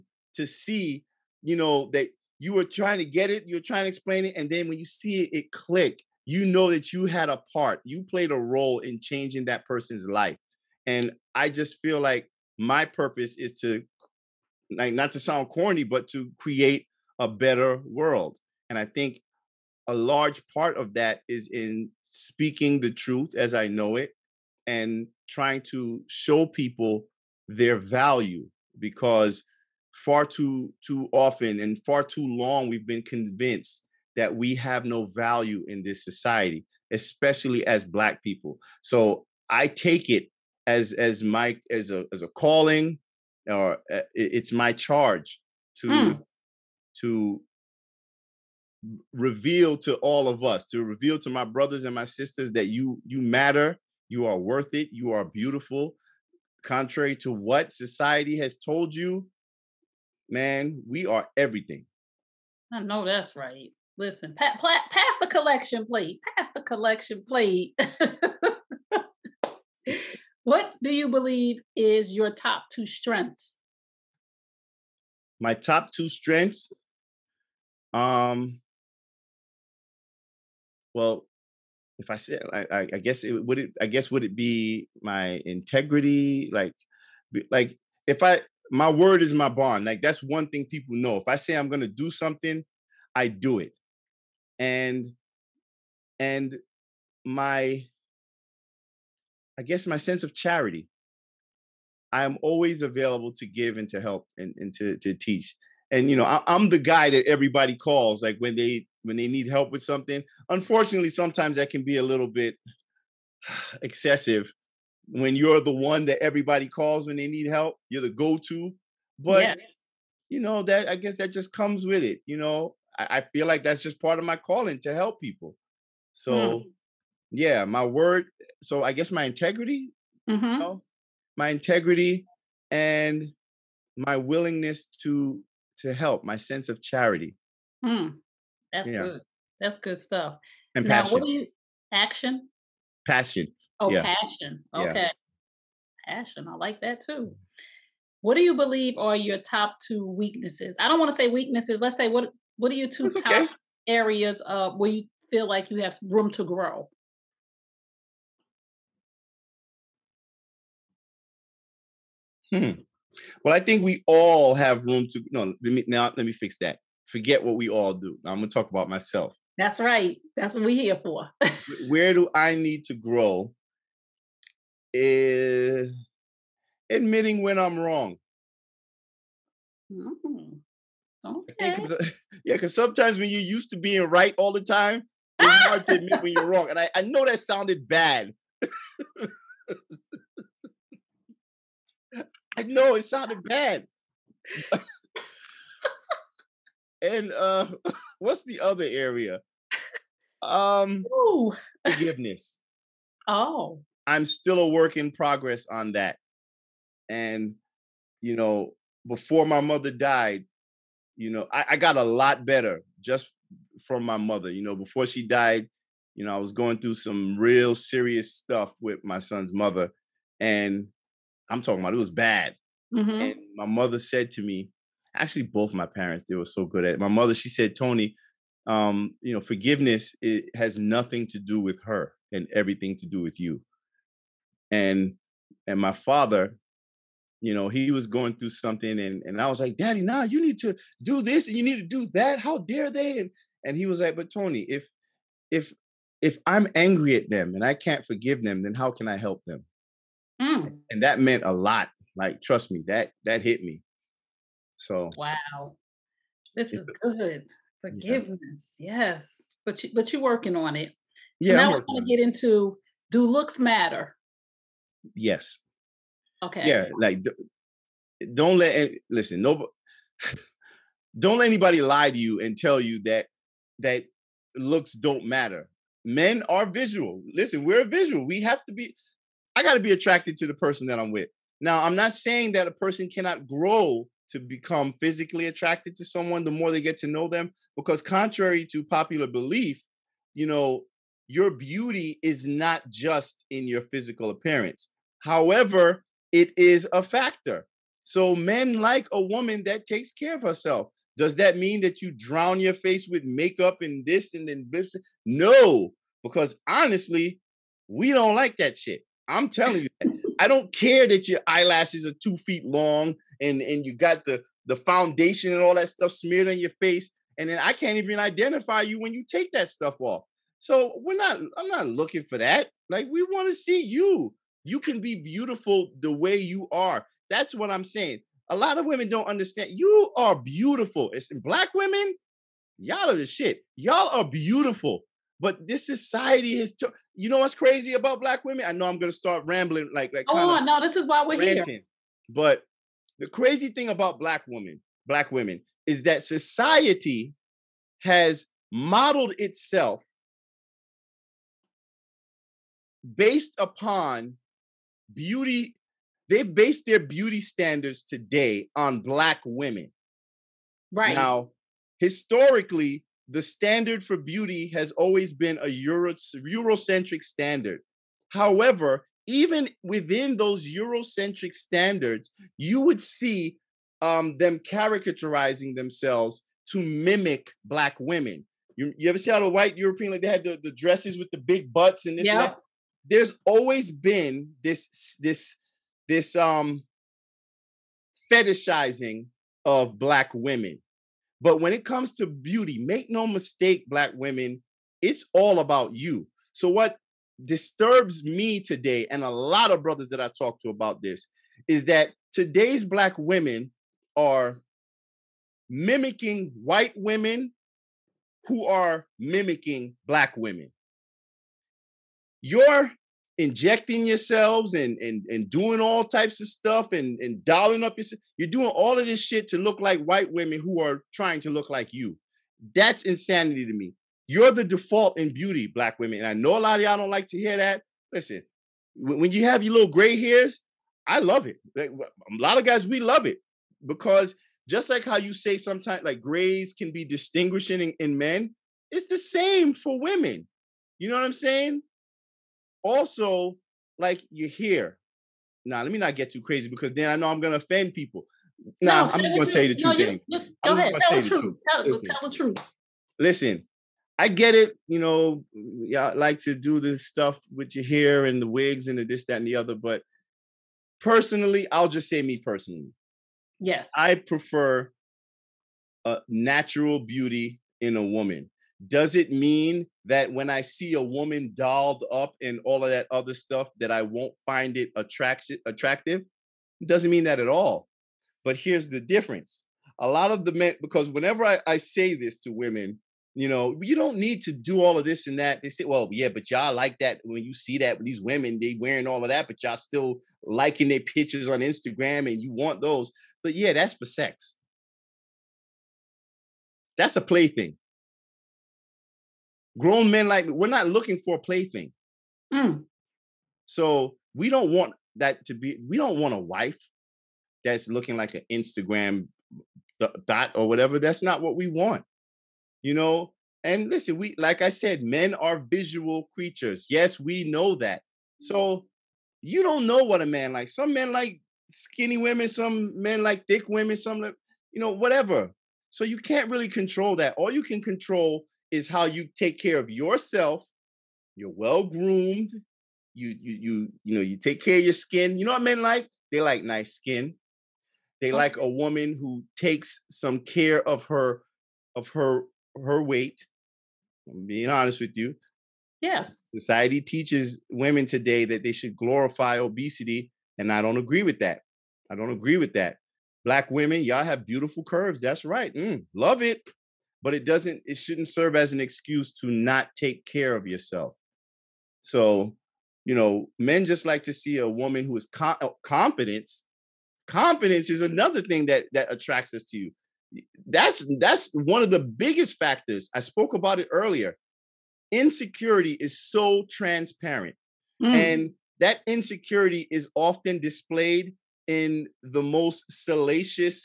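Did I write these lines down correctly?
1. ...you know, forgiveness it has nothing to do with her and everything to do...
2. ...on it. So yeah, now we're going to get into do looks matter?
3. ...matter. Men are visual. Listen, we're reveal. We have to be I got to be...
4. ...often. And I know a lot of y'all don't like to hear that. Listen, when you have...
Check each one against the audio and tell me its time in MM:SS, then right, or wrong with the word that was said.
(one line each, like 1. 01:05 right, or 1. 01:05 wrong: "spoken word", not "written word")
1. 03:49 right
2. 04:20 right
3. 04:35 wrong: "visual", not "reveal"
4. 07:05 wrong: "women", not "often".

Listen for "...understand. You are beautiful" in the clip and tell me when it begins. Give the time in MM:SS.
05:29.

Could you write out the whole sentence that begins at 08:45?
So you can't really control that.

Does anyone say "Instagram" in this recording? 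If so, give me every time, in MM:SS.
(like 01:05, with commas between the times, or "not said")
08:11, 08:28.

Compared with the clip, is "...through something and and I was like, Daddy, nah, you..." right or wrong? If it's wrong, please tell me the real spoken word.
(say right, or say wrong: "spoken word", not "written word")
right.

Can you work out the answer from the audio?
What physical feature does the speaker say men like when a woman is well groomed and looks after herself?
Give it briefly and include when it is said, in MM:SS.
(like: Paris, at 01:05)
nice skin, at 08:56.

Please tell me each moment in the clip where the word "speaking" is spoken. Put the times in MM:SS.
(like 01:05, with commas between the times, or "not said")
00:22.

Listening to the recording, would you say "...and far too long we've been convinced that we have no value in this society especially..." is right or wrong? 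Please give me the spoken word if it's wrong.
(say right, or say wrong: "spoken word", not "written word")
right.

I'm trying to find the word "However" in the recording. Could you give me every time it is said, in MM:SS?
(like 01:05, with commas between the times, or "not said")
04:55, 06:08.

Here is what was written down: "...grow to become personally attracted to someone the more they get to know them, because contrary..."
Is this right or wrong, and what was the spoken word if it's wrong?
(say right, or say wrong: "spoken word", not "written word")
wrong: "physically", not "personally".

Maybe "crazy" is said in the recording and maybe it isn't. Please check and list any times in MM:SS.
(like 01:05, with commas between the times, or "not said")
05:37, 05:43, 07:26.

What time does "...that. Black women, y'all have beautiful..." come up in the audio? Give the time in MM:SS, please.
09:12.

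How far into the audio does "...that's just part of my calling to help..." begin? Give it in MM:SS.
02:03.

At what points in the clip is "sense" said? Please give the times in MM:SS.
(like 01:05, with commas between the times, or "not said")
01:39, 02:16.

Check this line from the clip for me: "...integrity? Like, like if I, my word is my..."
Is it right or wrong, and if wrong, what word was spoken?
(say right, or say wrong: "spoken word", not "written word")
right.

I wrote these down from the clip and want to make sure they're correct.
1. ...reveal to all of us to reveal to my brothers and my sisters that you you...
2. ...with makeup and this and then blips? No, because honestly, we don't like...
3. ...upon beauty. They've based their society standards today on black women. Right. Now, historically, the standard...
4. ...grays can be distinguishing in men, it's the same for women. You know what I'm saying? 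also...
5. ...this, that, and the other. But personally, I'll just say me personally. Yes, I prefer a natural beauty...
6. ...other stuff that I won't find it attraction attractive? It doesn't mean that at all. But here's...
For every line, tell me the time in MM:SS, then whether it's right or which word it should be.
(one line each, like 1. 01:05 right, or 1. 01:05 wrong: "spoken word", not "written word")
1. 00:49 right
2. 05:03 right
3. 05:53 wrong: "beauty", not "society"
4. 07:16 right
5. 07:39 right
6. 07:53 right.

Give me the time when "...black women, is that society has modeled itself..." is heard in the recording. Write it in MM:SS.
05:45.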